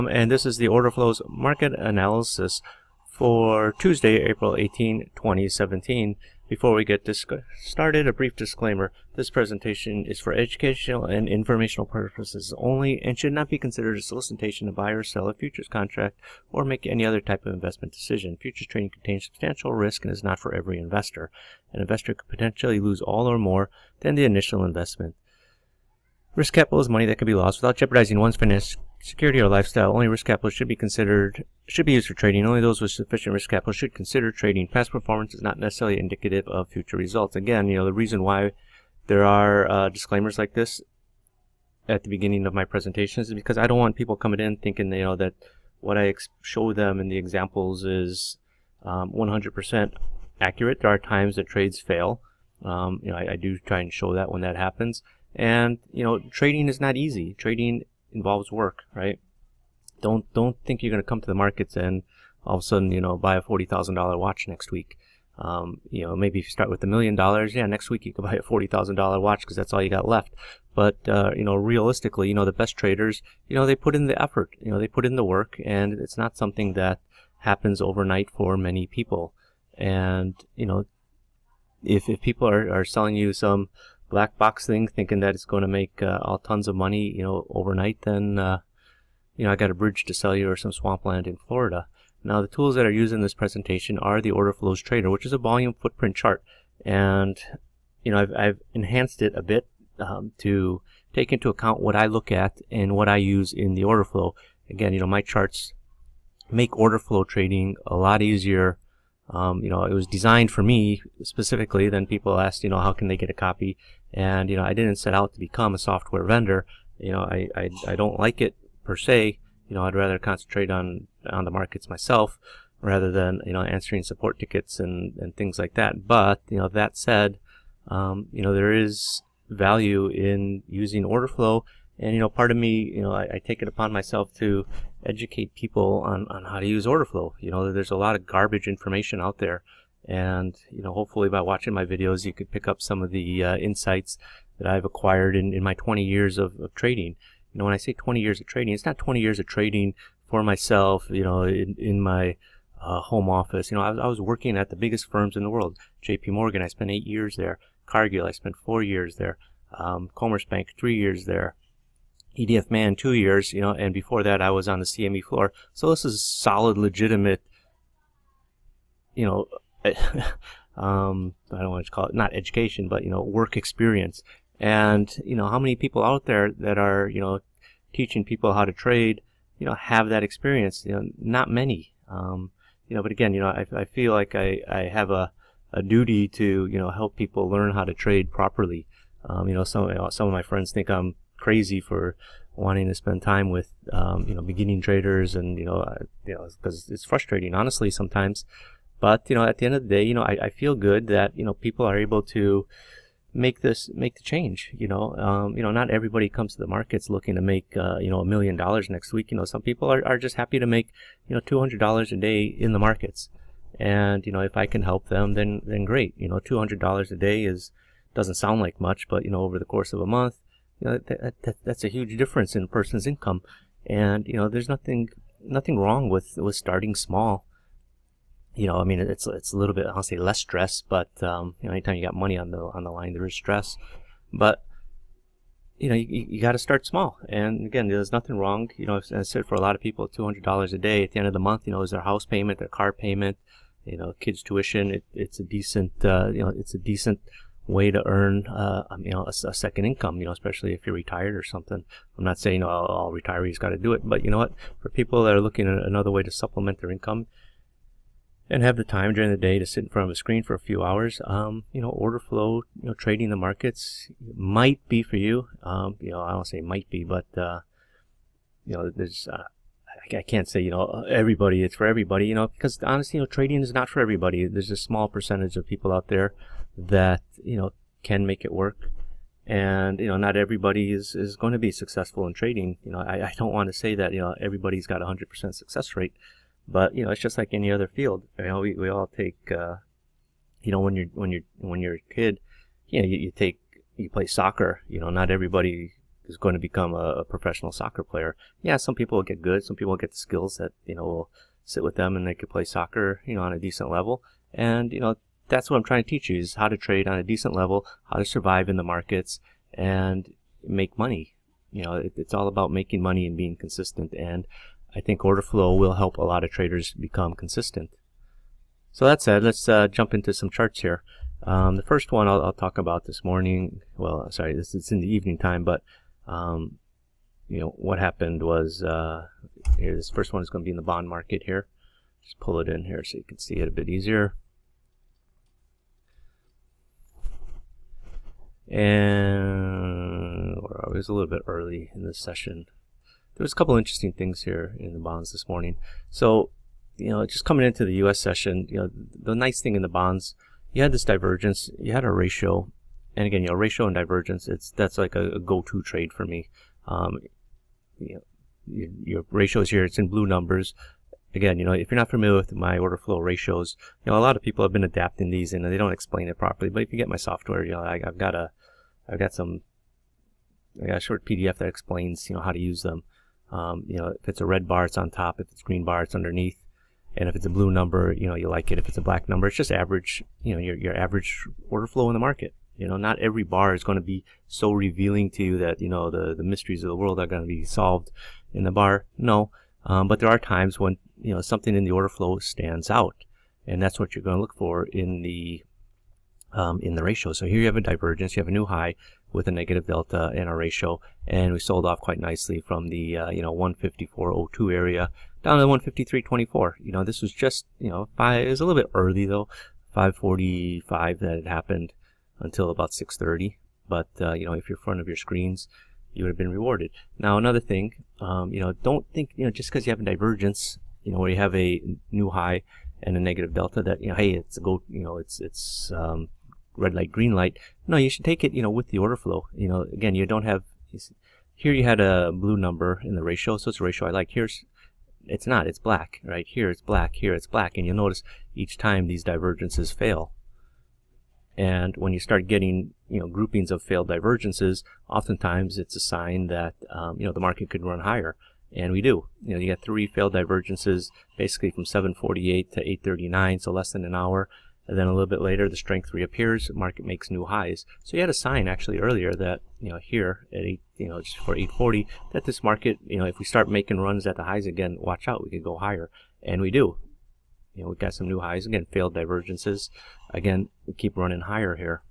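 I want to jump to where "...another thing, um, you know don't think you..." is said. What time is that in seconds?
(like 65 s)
417 s.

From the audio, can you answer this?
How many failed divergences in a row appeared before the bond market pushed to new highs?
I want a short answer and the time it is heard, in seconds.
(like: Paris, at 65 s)
3, at 449 s.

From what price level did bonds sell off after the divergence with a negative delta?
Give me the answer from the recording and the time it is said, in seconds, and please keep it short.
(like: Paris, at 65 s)
154.02, at 403 s.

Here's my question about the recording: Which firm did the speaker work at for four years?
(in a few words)
Cargill.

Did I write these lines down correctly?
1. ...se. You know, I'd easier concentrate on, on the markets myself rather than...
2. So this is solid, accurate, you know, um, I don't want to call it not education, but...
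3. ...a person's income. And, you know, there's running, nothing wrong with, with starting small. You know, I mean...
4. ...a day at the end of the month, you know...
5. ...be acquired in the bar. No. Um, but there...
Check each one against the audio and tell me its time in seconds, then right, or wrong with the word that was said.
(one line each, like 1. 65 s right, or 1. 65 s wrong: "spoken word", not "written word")
1. 118 s wrong: "rather", not "easier"
2. 165 s wrong: "legitimate", not "accurate"
3. 222 s wrong: "nothing", not "running"
4. 240 s right
5. 387 s wrong: "solved", not "acquired".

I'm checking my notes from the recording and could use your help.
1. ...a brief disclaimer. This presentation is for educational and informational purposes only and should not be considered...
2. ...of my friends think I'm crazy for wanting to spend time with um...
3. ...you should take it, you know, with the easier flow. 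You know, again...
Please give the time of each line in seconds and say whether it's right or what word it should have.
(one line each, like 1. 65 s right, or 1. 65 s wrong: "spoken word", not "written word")
1. 8 s right
2. 190 s right
3. 427 s wrong: "order", not "easier".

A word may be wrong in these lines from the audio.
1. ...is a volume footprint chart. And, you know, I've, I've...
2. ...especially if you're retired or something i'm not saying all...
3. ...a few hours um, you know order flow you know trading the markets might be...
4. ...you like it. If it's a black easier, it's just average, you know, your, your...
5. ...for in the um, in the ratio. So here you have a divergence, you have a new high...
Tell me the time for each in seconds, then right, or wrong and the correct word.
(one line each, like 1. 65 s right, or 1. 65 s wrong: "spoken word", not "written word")
1. 95 s right
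2. 250 s right
3. 260 s right
4. 378 s wrong: "number", not "easier"
5. 394 s right.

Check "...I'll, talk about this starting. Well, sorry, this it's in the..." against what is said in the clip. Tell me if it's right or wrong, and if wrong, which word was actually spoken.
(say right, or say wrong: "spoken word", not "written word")
wrong: "morning", not "starting".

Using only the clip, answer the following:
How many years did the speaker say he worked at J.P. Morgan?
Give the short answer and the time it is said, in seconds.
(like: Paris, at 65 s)
8 years, at 156 s.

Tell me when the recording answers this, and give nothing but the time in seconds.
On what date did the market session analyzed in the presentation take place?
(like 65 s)
4 s.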